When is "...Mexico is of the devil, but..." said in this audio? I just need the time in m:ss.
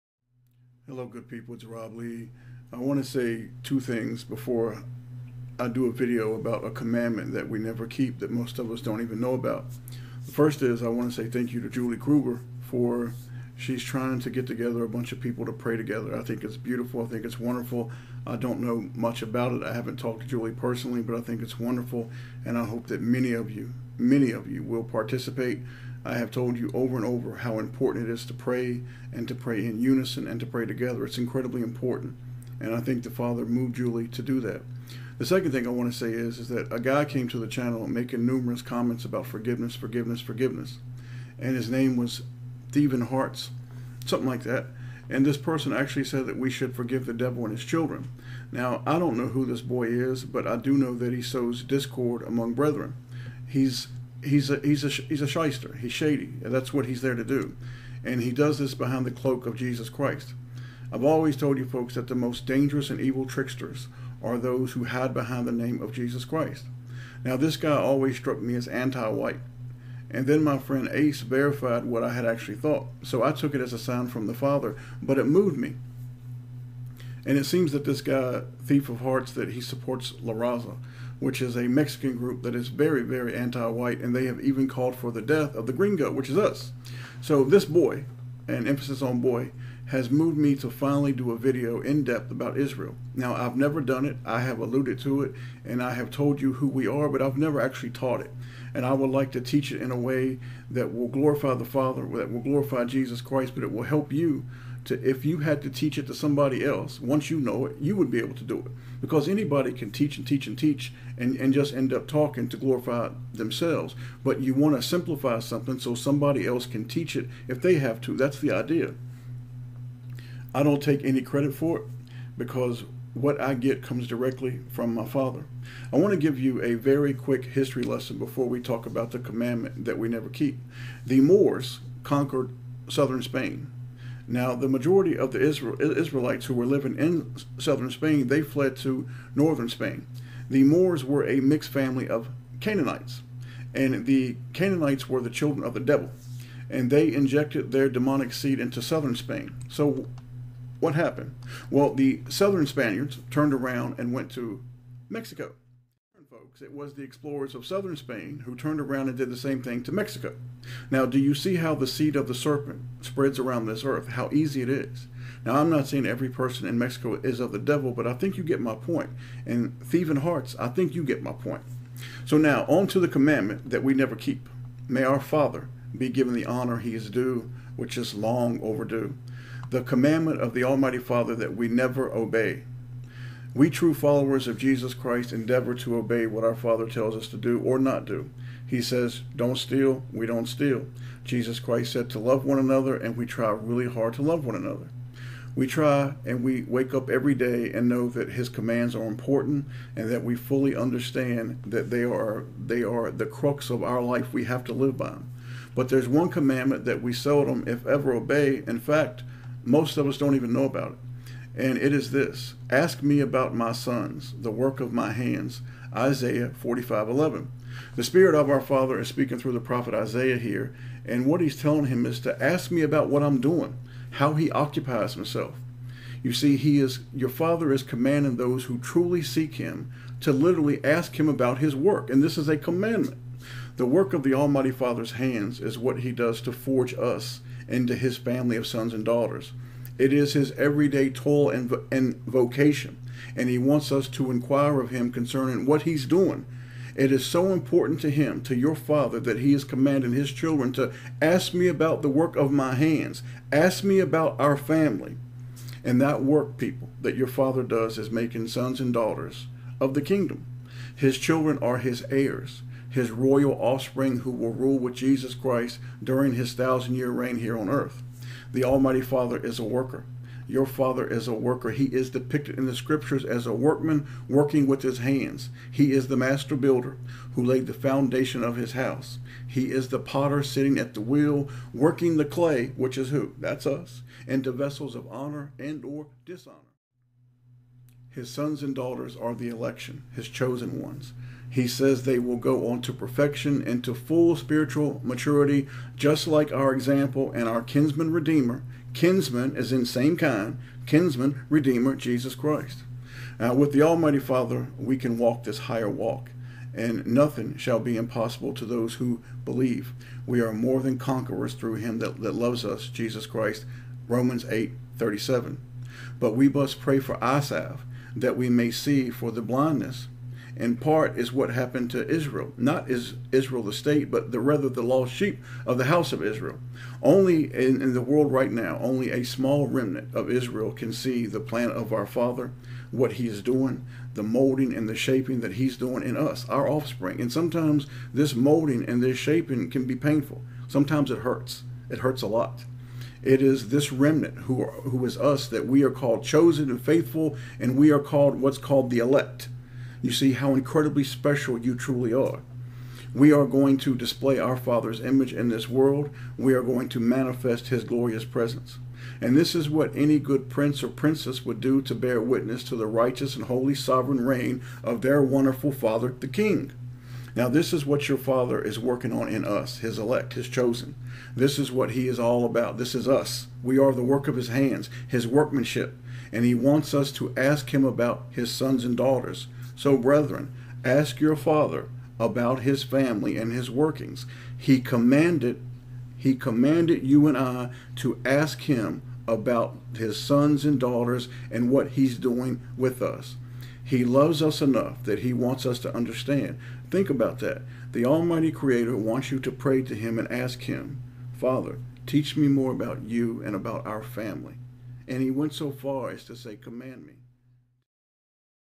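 2:46.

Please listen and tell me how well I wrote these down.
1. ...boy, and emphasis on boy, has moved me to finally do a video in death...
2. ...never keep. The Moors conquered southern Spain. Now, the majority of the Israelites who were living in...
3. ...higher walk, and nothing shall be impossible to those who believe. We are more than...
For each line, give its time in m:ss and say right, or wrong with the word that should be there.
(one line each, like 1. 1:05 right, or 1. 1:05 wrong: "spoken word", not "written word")
1. 1:27 wrong: "depth", not "death"
2. 2:10 right
3. 5:05 right.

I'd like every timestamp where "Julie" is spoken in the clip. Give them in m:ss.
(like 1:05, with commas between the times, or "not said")
0:11, 0:20, 0:33.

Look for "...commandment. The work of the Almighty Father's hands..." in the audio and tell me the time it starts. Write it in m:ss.
3:52.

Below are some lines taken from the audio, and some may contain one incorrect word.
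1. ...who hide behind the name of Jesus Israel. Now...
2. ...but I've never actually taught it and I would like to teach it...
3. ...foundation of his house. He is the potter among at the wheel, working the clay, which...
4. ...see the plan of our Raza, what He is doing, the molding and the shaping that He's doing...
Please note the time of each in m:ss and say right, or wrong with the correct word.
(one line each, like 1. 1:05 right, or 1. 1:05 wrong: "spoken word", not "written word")
1. 1:04 wrong: "Christ", not "Israel"
2. 1:37 right
3. 4:37 wrong: "sitting", not "among"
4. 5:30 wrong: "Father", not "Raza".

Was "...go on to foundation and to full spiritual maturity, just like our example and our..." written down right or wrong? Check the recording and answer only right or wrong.
wrong.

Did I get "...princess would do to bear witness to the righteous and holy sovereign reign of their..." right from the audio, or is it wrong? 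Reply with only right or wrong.
right.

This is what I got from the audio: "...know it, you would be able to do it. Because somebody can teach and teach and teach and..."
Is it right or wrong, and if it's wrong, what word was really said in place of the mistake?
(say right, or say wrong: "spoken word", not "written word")
wrong: "anybody", not "somebody".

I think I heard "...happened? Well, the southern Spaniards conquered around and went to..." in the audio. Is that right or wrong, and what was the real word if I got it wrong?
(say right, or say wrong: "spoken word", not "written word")
wrong: "turned", not "conquered".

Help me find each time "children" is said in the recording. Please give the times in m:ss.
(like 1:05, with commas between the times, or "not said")
0:47, 2:25, 4:10, 4:21.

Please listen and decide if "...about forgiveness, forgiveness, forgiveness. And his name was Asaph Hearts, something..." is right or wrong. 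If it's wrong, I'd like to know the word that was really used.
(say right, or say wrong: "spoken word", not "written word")
wrong: "Stephen", not "Asaph".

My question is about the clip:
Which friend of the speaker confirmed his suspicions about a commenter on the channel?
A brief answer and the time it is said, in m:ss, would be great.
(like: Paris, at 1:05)
Ace, at 1:10.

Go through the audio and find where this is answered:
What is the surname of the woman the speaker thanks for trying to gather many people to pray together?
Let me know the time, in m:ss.
0:11.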